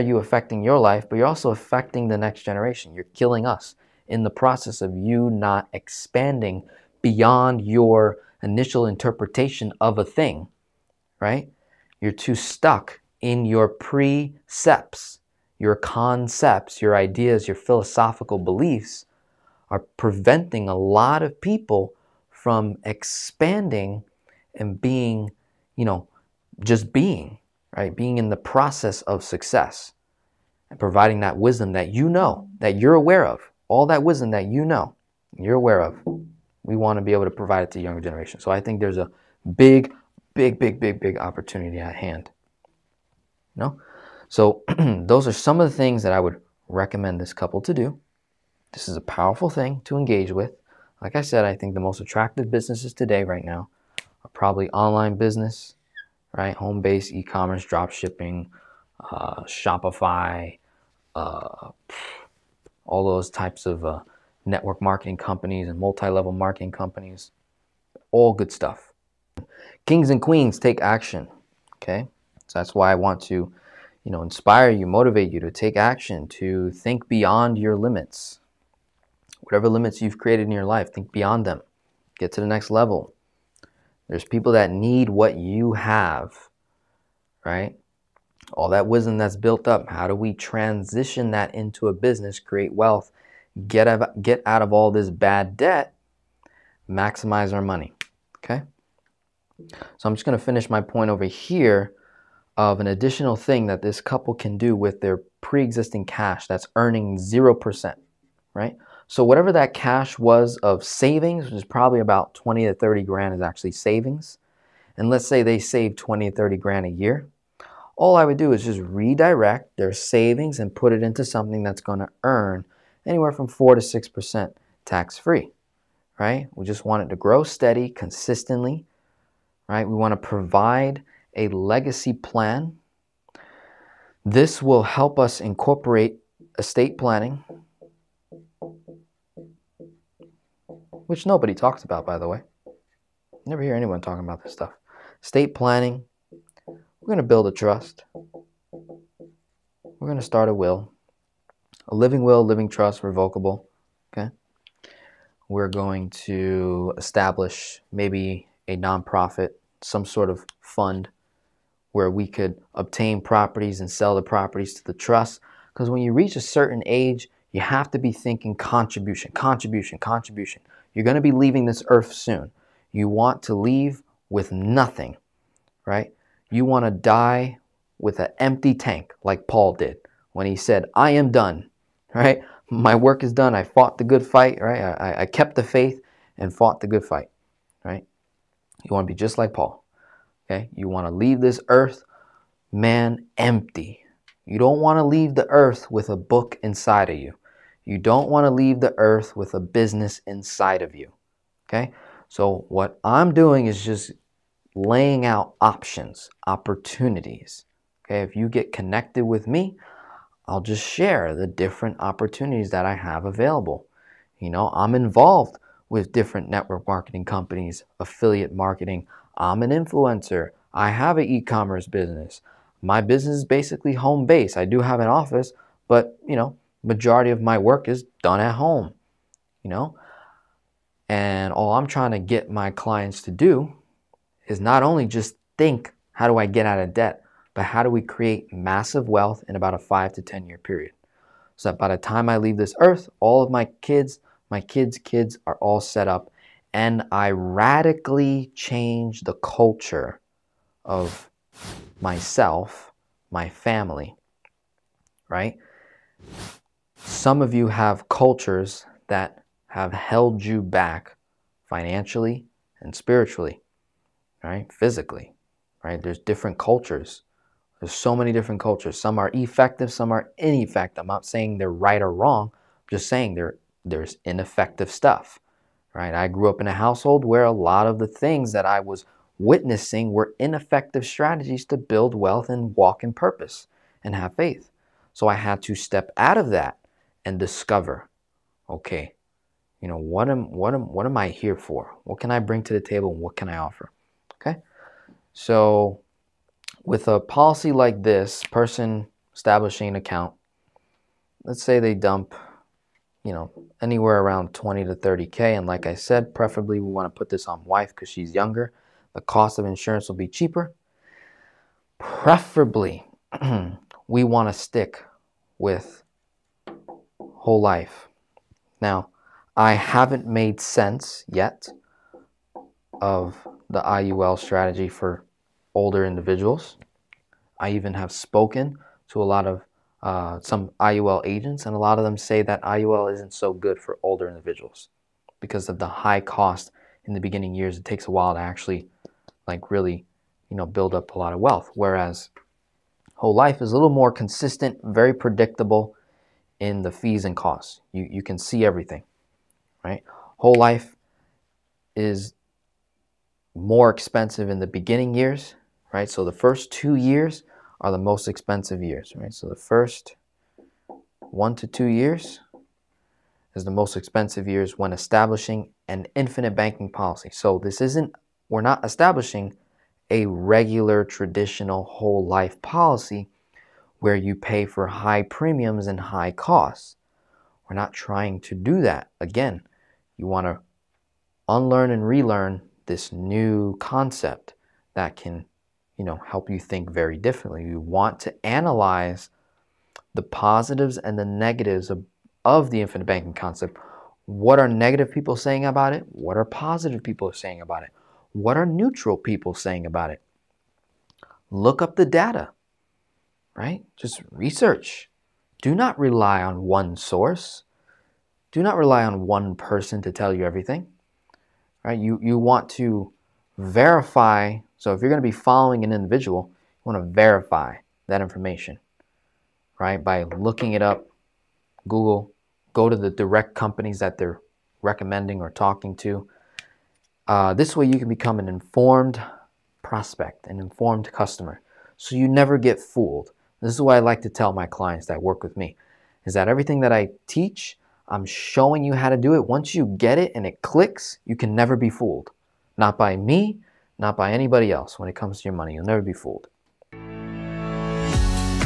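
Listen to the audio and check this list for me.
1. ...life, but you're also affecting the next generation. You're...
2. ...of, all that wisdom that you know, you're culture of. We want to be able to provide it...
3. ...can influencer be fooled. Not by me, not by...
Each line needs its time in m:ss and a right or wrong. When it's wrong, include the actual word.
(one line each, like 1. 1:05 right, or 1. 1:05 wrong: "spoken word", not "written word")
1. 0:00 right
2. 0:33 wrong: "aware", not "culture"
3. 7:21 wrong: "never", not "influencer".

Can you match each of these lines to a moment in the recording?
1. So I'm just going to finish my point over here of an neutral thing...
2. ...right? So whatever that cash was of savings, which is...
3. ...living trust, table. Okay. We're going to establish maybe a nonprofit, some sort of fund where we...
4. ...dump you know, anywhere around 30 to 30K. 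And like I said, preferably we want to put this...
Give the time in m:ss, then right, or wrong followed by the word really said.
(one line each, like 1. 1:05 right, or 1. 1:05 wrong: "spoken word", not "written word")
1. 1:39 wrong: "additional", not "neutral"
2. 1:48 right
3. 2:32 wrong: "revocable", not "table"
4. 5:01 wrong: "20", not "30".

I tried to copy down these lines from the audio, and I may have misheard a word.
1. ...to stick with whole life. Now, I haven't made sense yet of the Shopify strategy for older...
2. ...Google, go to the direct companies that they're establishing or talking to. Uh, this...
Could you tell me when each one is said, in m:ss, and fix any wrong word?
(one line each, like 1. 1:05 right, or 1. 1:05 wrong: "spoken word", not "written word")
1. 5:14 wrong: "IUL", not "Shopify"
2. 7:01 wrong: "recommending", not "establishing".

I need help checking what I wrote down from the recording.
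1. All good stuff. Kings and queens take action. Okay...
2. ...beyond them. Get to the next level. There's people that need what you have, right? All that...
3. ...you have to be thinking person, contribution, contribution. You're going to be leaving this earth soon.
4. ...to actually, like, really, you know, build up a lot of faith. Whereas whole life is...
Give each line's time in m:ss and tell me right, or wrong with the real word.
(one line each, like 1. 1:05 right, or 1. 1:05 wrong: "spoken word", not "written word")
1. 1:08 right
2. 1:21 right
3. 2:47 wrong: "contribution", not "person"
4. 5:38 wrong: "wealth", not "faith".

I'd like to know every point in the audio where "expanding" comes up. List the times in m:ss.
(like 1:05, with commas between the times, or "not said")
0:05, 0:22.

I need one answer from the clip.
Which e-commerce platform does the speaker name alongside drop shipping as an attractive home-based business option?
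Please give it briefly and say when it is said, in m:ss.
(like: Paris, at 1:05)
Shopify, at 0:59.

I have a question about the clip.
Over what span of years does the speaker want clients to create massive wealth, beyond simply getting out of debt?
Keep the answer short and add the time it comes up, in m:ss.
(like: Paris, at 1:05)
5 to 10 years, at 3:59.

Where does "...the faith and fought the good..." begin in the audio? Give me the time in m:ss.
3:05.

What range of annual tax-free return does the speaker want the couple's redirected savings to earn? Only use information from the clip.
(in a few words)
4 to 6%.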